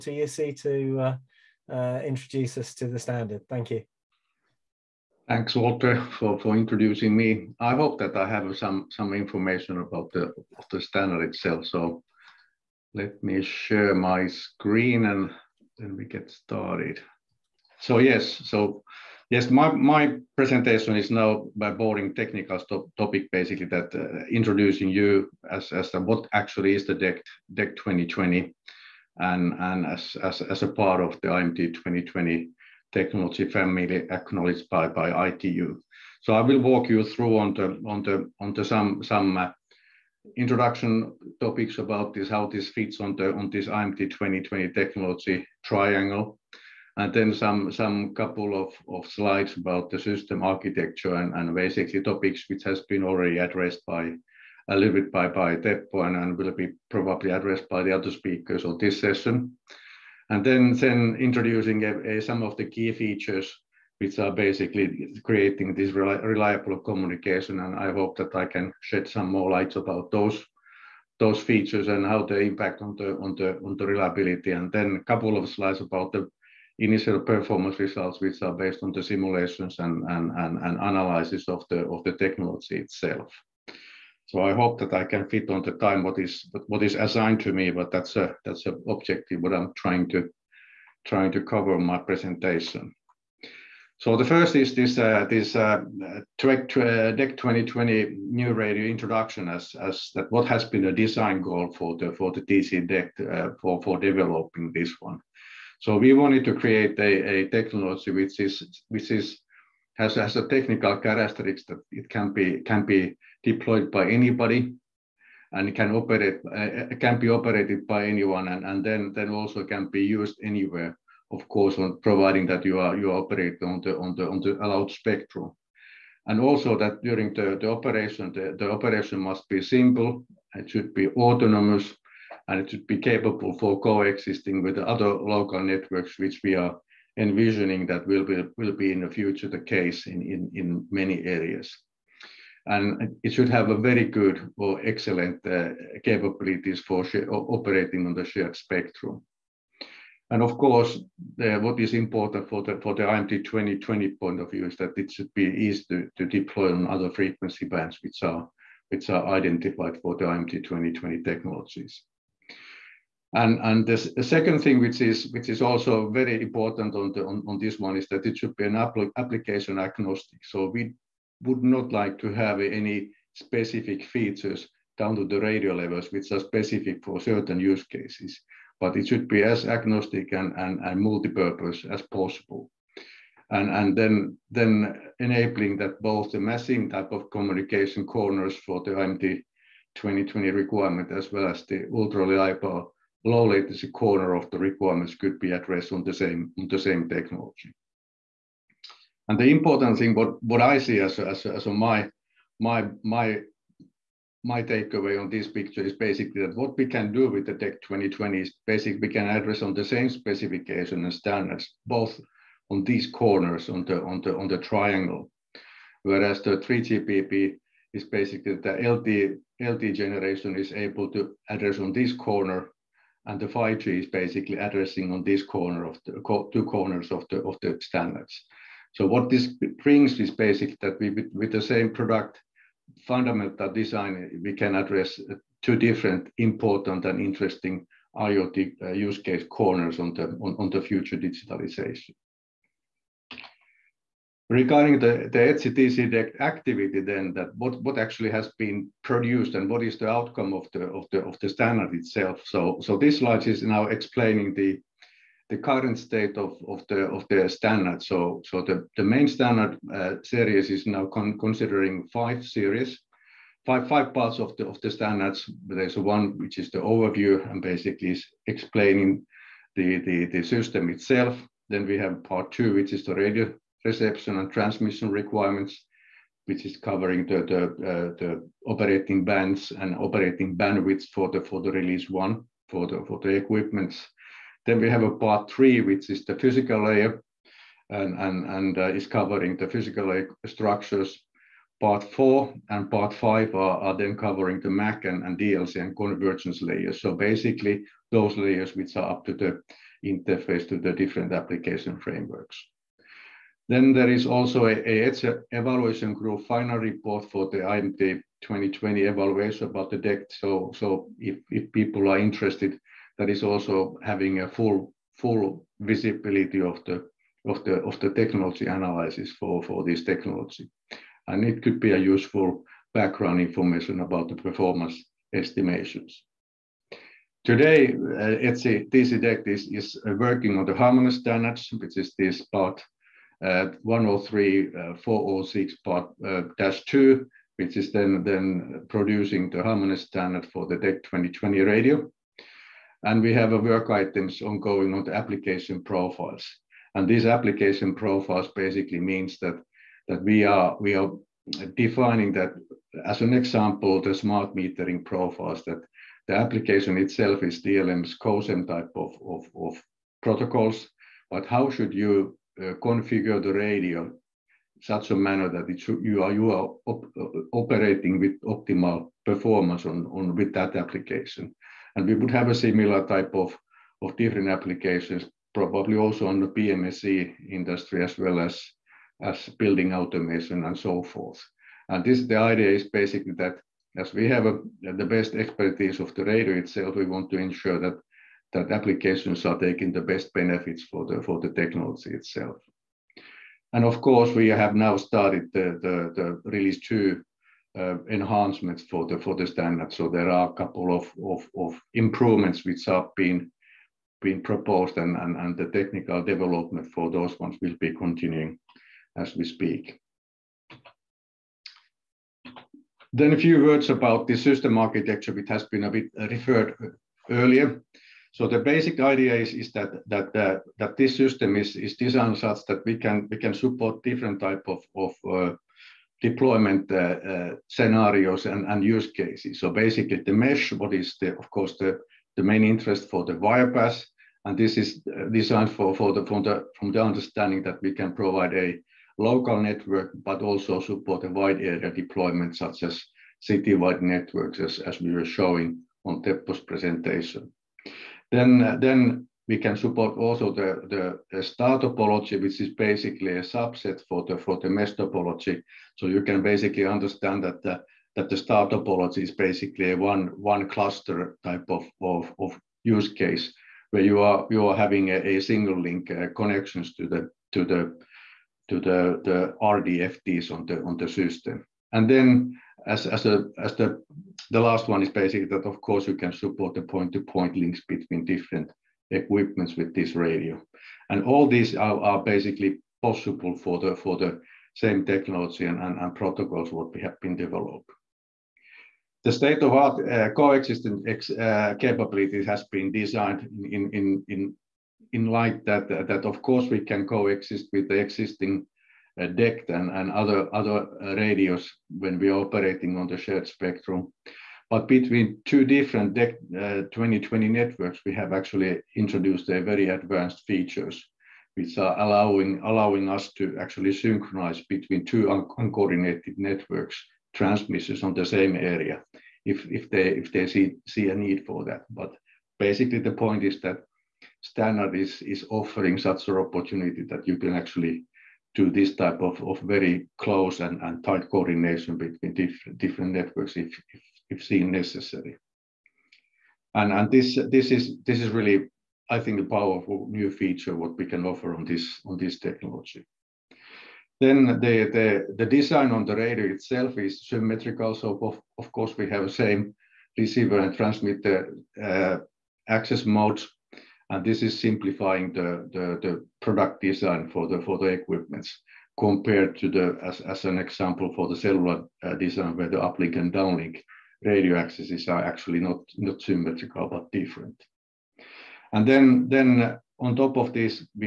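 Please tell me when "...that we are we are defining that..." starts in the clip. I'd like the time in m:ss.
5:49.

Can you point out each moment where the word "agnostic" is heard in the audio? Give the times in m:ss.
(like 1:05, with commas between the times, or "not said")
2:49, 2:59.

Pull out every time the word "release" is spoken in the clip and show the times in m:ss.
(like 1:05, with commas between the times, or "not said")
4:41, 6:36.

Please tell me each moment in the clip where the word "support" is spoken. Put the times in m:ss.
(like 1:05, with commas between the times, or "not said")
7:03, 7:20, 7:29, 7:56.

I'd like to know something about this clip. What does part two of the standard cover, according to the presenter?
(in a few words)
radio reception and transmission requirements.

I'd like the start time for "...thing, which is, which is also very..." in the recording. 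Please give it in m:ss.
2:44.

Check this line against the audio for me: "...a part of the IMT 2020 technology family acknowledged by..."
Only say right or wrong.
right.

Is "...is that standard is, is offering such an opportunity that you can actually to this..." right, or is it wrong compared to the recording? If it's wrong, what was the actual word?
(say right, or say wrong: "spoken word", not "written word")
right.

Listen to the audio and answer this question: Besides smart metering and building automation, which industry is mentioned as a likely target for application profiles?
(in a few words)
PMSE.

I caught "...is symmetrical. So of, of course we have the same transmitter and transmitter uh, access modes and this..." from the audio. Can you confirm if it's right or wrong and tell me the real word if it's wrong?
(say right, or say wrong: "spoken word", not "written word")
wrong: "receiver", not "transmitter".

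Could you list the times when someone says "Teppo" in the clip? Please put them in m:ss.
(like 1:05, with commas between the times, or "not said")
0:55, 7:26.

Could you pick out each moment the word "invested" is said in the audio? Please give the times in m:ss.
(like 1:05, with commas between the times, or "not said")
not said.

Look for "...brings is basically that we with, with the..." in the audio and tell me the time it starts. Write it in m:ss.
3:49.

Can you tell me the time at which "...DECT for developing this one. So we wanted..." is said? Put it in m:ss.
1:42.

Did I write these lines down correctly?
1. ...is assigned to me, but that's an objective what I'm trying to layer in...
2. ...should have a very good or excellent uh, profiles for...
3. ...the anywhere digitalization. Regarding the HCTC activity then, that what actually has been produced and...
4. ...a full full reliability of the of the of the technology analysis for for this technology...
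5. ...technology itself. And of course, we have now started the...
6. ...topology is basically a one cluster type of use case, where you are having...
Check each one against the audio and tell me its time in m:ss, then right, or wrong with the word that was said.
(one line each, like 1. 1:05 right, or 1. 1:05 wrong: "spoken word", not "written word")
1. 1:26 wrong: "cover", not "layer"
2. 2:23 wrong: "capabilities", not "profiles"
3. 4:00 wrong: "future", not "anywhere"
4. 5:14 wrong: "visibility", not "reliability"
5. 6:31 right
6. 7:38 right.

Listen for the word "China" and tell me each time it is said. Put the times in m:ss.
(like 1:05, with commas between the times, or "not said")
not said.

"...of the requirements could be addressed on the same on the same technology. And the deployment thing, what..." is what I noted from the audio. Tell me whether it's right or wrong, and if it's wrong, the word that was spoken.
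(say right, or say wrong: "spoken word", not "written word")
wrong: "important", not "deployment".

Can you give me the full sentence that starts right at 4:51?
Part four and part five are, are then covering the MAC and, and DLC and convergence layers.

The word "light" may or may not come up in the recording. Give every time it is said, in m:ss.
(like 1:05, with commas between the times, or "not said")
1:09, 8:15.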